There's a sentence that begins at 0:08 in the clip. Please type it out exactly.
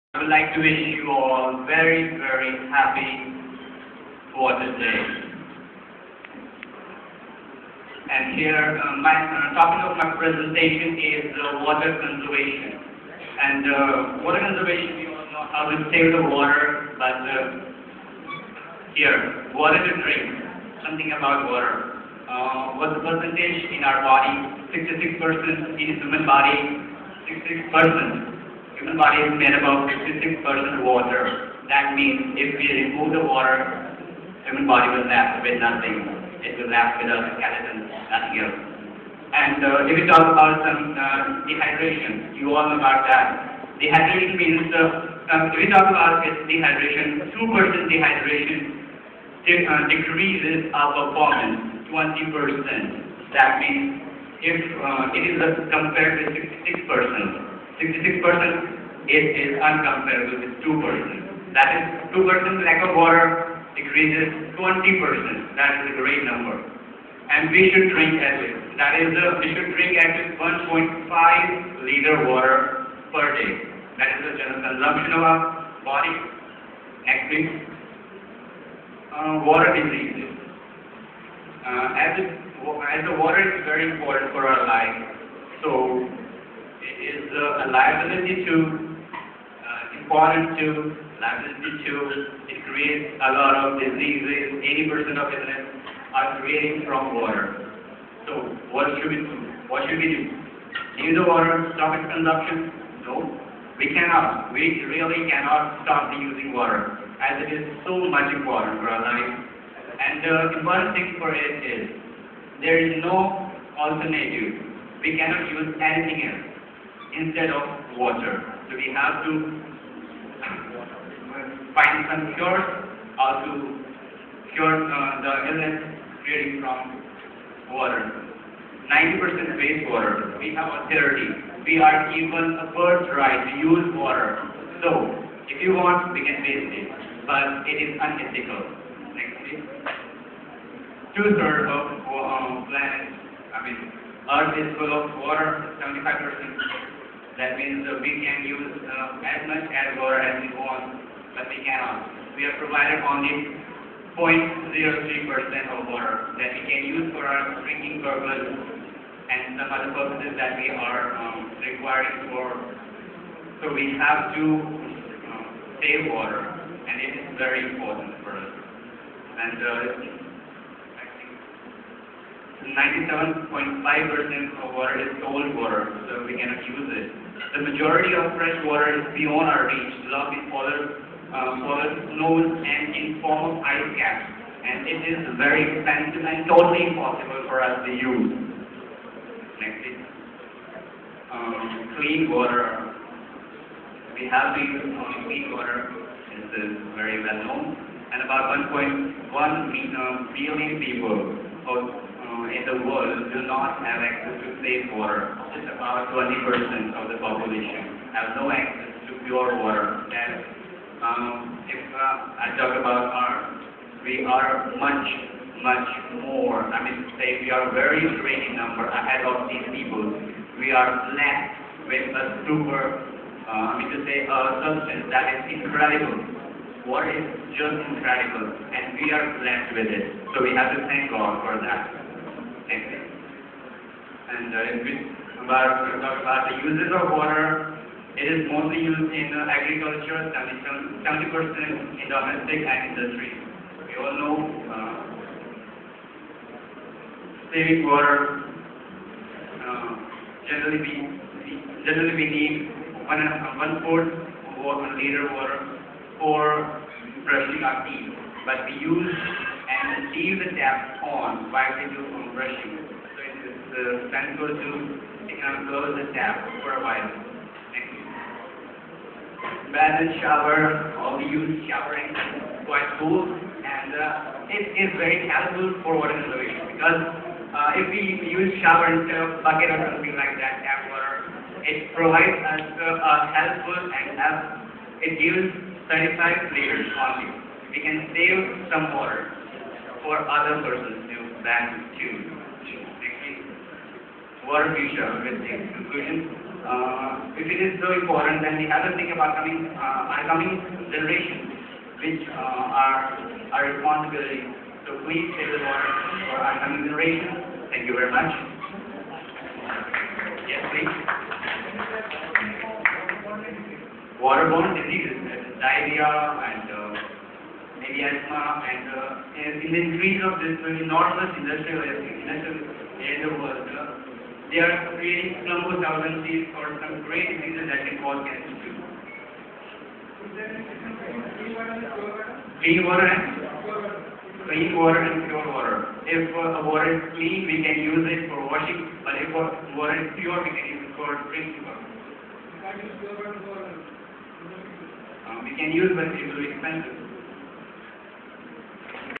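And here, uh, my uh, topic of my presentation is uh, water conservation.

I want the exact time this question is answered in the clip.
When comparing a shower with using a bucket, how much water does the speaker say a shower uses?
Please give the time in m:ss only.
4:45.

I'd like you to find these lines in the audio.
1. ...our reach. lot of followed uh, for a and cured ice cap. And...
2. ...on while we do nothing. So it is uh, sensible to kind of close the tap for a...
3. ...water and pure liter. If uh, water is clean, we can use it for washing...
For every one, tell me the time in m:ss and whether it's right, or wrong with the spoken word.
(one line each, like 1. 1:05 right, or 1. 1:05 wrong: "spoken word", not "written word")
1. 2:59 wrong: "informed", not "cured"
2. 4:21 wrong: "brushing", not "nothing"
3. 5:34 wrong: "water", not "liter".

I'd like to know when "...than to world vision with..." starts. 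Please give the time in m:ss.
4:51.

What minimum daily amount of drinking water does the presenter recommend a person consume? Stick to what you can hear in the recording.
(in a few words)
1.5 liters.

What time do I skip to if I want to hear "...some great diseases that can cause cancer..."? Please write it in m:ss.
5:26.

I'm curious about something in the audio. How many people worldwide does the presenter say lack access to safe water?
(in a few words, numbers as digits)
1.1 billion.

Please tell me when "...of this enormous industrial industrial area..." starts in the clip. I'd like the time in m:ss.
5:20.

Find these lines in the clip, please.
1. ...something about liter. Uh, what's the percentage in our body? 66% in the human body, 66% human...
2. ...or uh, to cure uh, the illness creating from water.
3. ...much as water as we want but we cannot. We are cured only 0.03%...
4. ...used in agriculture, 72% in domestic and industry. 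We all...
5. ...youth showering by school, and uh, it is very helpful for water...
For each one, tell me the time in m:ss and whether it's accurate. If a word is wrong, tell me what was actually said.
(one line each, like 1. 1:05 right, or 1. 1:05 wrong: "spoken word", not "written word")
1. 0:20 wrong: "water", not "liter"
2. 2:03 right
3. 2:29 wrong: "provided", not "cured"
4. 3:58 wrong: "70", not "72"
5. 4:31 right.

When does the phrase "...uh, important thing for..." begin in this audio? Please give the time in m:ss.
1:50.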